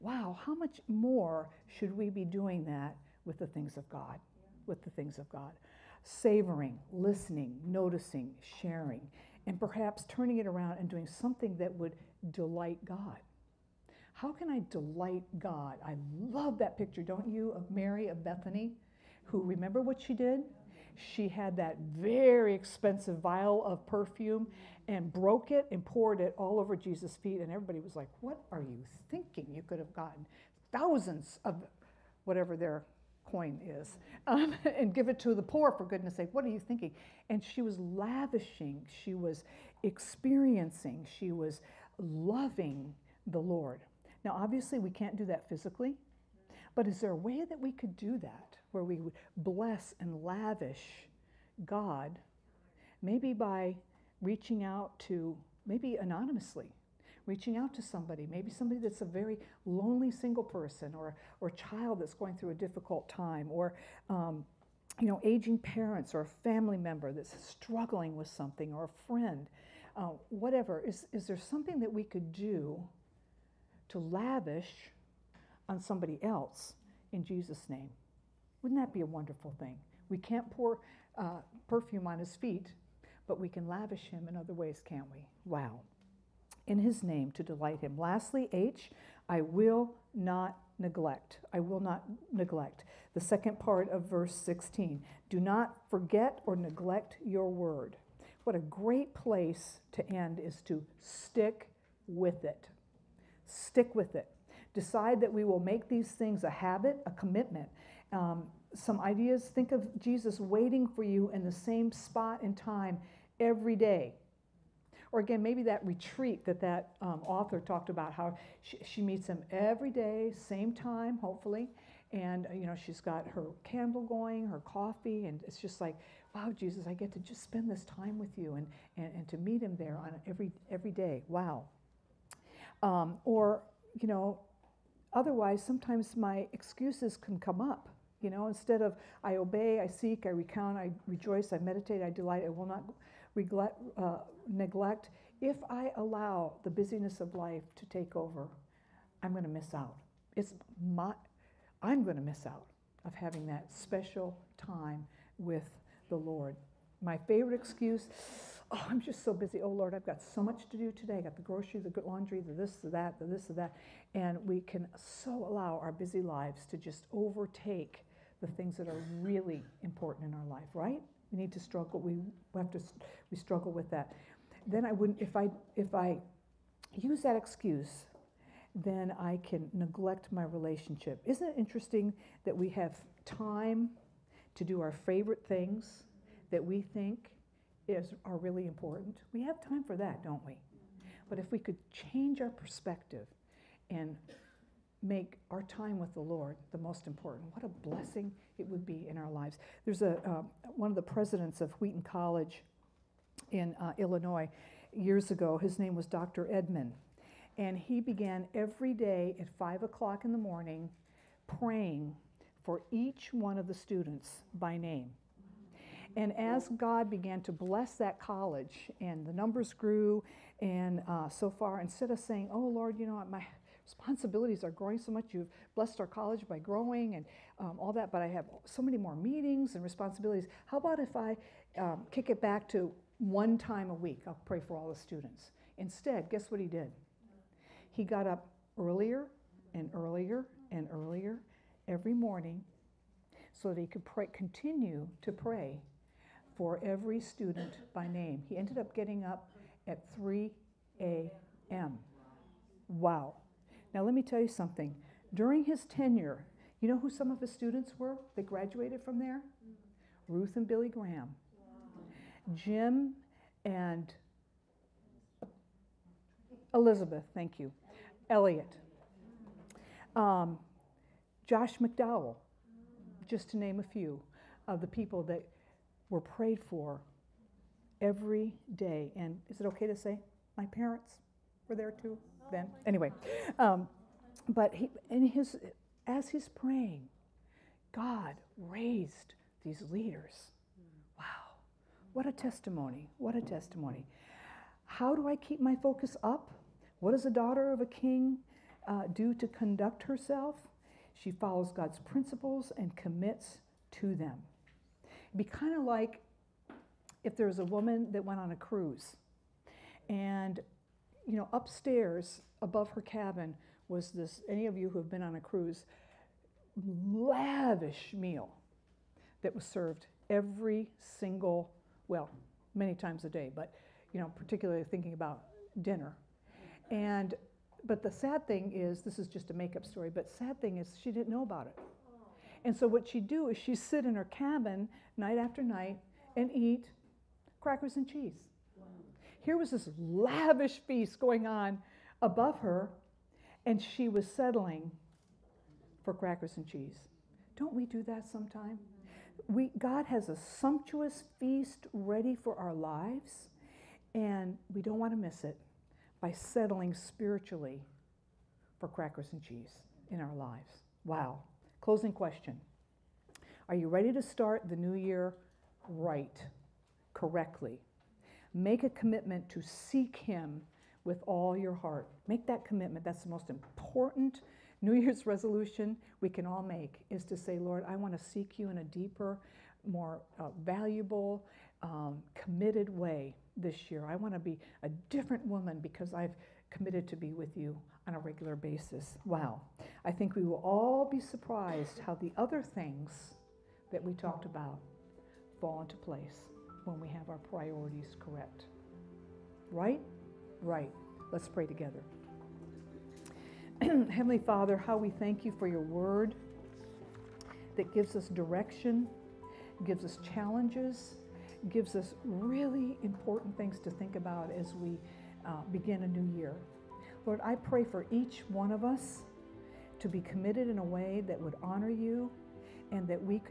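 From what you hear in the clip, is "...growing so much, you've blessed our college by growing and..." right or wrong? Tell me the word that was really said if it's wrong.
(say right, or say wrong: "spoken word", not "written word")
right.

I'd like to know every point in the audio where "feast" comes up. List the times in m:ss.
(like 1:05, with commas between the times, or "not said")
5:40, 5:51.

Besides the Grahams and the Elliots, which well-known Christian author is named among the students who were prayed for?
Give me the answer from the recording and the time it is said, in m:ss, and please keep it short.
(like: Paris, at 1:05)
Josh McDowell, at 4:31.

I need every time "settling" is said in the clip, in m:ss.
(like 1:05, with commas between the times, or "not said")
5:44, 5:56.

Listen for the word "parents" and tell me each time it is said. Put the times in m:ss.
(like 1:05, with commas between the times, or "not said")
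1:05, 4:40.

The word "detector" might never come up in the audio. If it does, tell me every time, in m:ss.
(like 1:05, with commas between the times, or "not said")
not said.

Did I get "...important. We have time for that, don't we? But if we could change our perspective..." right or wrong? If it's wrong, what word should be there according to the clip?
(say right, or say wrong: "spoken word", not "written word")
right.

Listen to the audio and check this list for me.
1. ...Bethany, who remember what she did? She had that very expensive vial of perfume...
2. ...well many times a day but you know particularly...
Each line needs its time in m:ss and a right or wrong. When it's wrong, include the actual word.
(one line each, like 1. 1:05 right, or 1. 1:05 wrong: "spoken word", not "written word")
1. 0:18 right
2. 5:22 right.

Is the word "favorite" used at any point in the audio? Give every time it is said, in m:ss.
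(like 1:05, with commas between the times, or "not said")
2:37, 3:04.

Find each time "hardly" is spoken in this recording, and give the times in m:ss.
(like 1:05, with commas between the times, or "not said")
not said.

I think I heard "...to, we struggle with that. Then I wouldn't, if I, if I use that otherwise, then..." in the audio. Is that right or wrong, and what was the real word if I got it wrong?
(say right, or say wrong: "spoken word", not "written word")
wrong: "excuse", not "otherwise".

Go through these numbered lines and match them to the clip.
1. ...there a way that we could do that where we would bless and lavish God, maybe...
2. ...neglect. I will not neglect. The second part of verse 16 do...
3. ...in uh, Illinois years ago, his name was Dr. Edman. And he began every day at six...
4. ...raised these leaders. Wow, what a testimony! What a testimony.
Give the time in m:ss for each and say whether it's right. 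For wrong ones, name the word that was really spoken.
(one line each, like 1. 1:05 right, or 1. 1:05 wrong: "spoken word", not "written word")
1. 0:46 right
2. 1:30 right
3. 3:23 wrong: "five", not "six"
4. 4:48 right.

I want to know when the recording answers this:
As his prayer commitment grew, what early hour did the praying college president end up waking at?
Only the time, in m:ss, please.
4:10.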